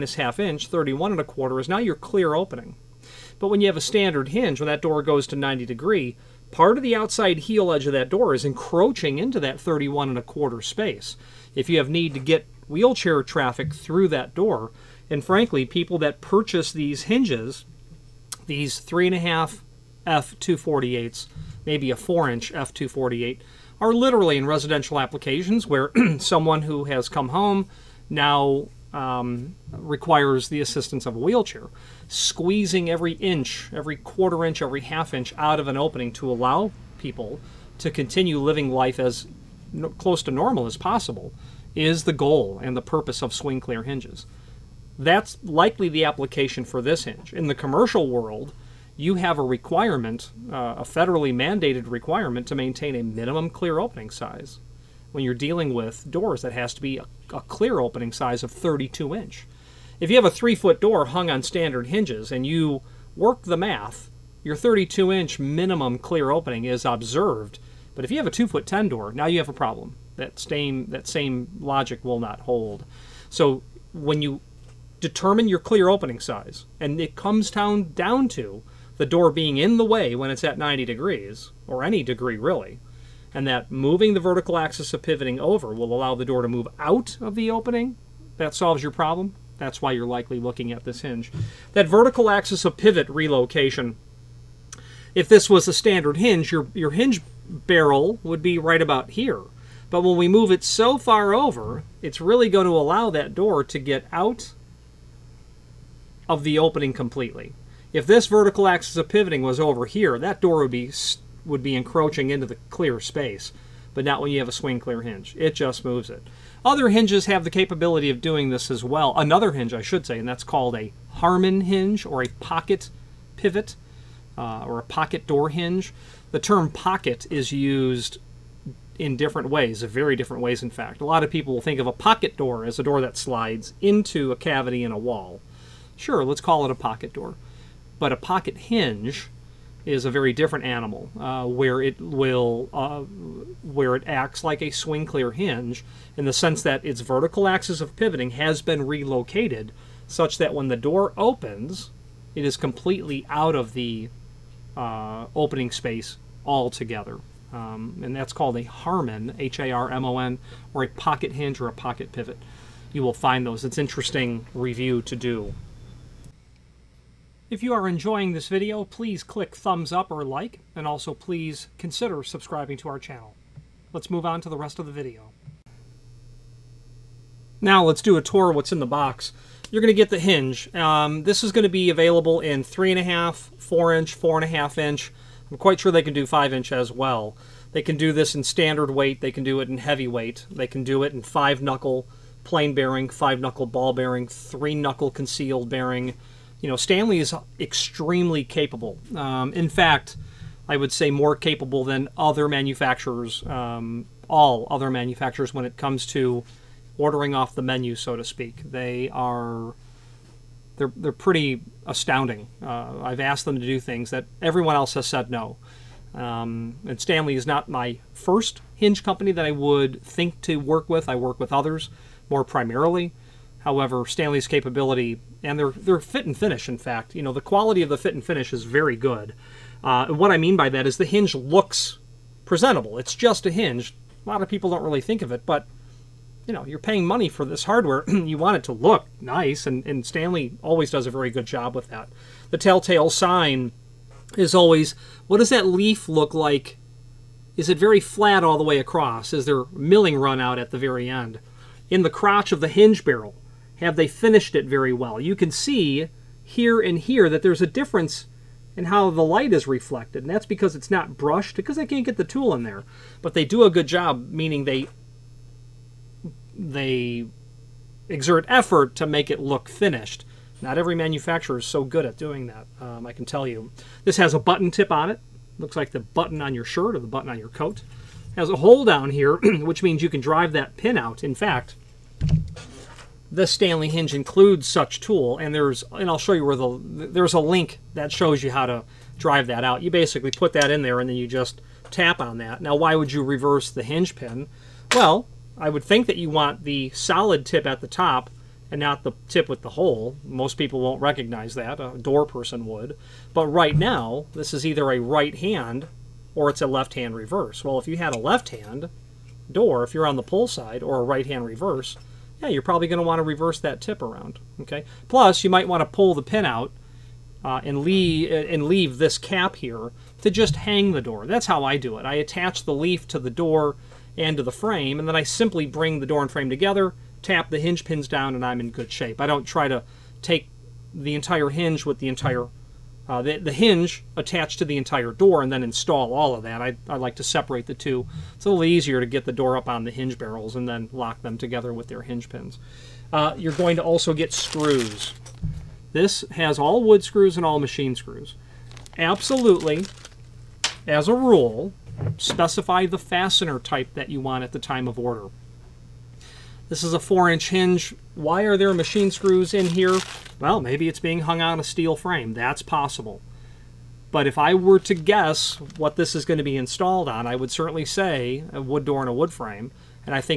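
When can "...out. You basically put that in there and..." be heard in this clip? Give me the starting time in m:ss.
4:49.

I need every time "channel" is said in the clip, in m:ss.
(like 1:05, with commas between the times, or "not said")
2:52.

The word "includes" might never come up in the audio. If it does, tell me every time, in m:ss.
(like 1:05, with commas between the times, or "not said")
4:44.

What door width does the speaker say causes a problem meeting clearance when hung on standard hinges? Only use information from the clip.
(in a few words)
2 foot 10.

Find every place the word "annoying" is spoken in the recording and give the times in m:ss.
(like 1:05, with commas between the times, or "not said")
not said.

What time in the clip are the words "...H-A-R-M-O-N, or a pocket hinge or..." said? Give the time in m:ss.
2:39.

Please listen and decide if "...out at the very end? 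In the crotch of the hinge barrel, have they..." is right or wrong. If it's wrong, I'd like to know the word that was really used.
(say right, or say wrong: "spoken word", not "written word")
right.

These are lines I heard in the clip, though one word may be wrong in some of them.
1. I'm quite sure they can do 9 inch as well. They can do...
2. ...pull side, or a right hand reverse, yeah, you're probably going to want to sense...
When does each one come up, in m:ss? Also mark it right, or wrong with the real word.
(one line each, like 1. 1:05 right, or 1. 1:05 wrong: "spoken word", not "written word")
1. 3:05 wrong: "5", not "9"
2. 5:10 wrong: "reverse", not "sense".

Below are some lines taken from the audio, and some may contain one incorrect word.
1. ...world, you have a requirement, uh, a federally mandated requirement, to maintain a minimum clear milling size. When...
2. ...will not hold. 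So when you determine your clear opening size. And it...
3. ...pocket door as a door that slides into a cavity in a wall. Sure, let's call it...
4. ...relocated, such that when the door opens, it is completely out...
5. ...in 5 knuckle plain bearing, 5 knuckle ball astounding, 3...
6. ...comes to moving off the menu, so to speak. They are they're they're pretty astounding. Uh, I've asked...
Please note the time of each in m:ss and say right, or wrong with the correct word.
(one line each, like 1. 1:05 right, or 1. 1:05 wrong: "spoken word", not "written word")
1. 0:48 wrong: "opening", not "milling"
2. 1:12 right
3. 2:11 right
4. 2:28 right
5. 3:11 wrong: "bearing", not "astounding"
6. 3:25 wrong: "ordering", not "moving".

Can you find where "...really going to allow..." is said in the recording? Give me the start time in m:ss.
1:42.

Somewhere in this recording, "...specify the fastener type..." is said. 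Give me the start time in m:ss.
5:52.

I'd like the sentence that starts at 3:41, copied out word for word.
I work with others more primarily.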